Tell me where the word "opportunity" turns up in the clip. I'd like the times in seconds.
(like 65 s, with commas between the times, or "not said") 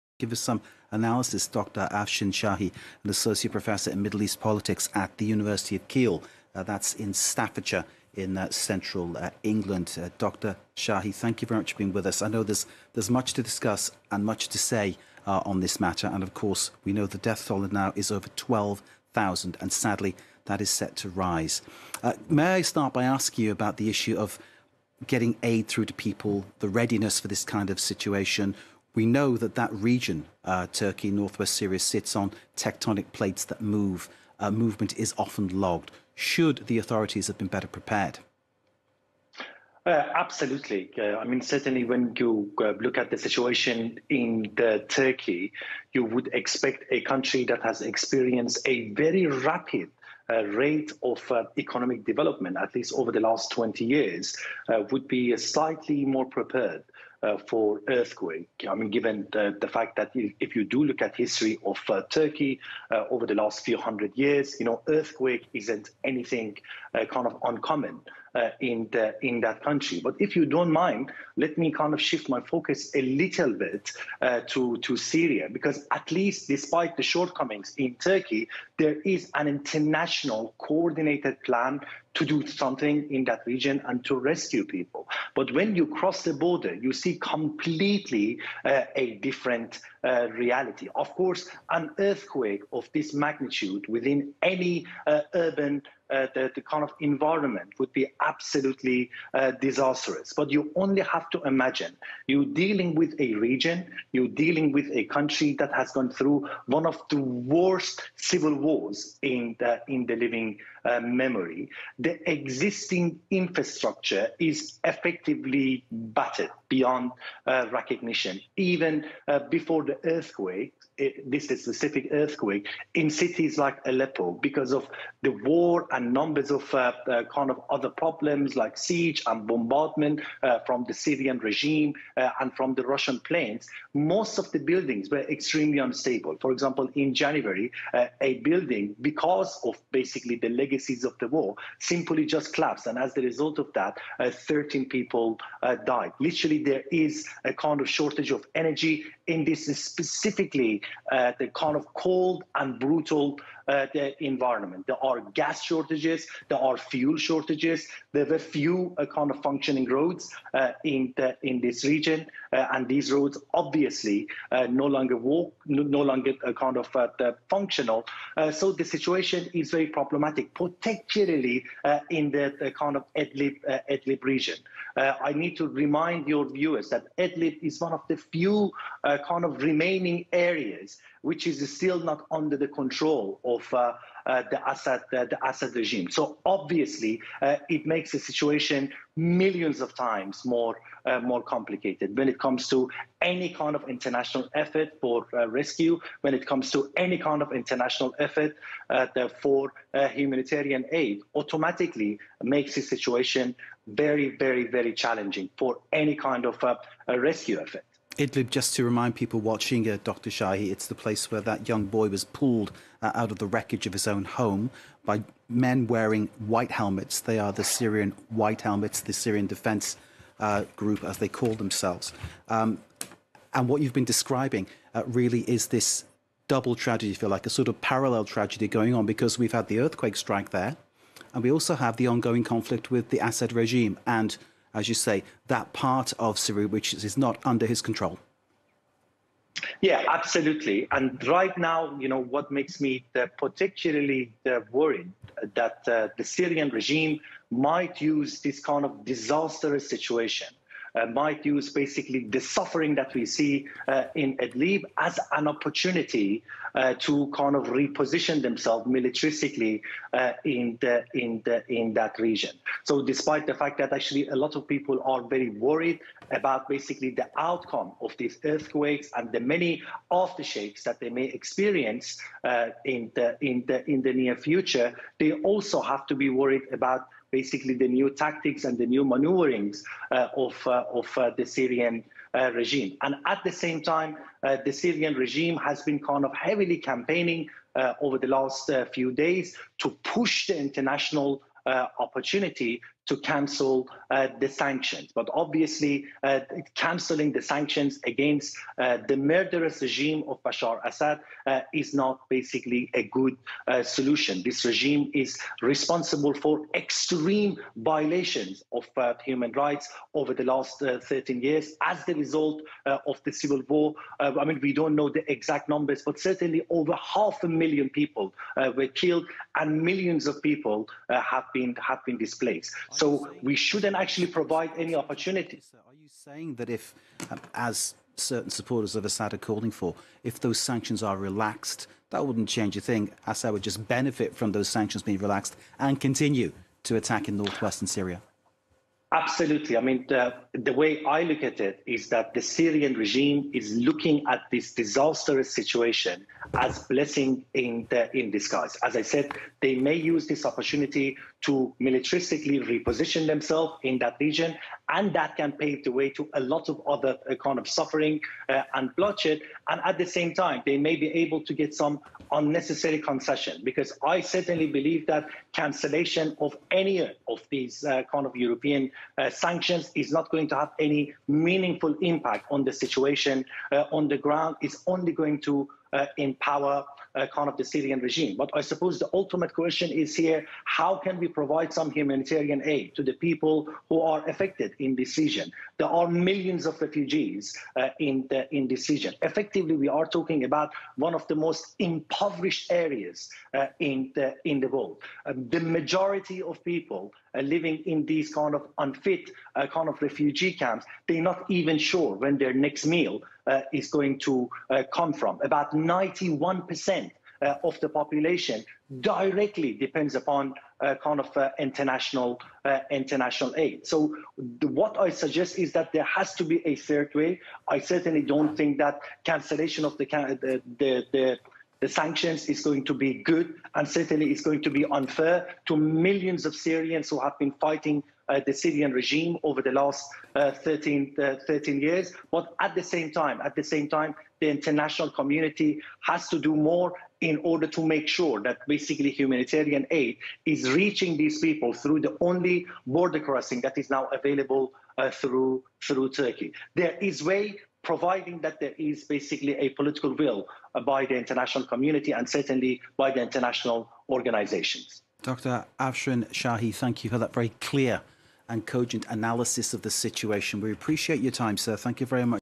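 255 s, 291 s, 324 s, 350 s.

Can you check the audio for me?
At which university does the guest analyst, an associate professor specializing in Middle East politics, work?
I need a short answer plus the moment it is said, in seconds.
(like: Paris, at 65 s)
University of Keele, at 5 s.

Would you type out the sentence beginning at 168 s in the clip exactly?
so the situation is very problematic, particularly in the, kind of Idlib, Idlib region.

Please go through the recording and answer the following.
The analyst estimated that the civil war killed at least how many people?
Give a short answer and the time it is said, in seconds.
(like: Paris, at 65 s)
half a million, at 316 s.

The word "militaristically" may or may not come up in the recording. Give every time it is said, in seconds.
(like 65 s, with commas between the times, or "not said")
258 s, 351 s.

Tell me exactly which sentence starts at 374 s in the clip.
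It's only going to uh, empower uh, kind of the Syrian regime.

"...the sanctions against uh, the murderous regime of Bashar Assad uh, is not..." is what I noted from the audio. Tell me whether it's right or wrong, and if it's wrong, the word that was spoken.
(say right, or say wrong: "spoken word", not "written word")
right.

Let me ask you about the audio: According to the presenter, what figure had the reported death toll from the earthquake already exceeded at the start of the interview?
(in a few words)
12,000.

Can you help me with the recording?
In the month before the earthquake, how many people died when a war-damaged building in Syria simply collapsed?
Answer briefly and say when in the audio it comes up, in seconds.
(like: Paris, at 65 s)
13, at 144 s.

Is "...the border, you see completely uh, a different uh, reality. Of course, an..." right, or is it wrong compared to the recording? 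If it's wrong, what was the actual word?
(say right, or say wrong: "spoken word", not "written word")
right.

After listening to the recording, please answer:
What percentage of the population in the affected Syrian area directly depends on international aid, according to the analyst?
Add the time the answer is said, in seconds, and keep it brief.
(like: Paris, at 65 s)
91%, at 405 s.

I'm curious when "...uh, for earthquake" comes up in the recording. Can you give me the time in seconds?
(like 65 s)
57 s.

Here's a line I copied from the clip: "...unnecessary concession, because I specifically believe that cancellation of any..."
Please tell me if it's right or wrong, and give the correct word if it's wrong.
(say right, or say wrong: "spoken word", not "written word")
wrong: "certainly", not "specifically".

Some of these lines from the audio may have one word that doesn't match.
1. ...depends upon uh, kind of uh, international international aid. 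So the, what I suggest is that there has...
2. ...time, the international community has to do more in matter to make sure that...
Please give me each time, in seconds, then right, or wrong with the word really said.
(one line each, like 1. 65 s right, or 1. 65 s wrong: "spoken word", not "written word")
1. 409 s right
2. 433 s wrong: "order", not "matter".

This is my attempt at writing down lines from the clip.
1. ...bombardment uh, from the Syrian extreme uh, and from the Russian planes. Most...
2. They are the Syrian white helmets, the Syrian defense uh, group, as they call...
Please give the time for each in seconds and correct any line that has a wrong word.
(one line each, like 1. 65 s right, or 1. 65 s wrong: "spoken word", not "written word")
1. 129 s wrong: "regime", not "extreme"
2. 217 s right.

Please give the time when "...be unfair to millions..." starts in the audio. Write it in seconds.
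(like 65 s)
424 s.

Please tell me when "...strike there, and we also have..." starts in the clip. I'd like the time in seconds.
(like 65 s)
230 s.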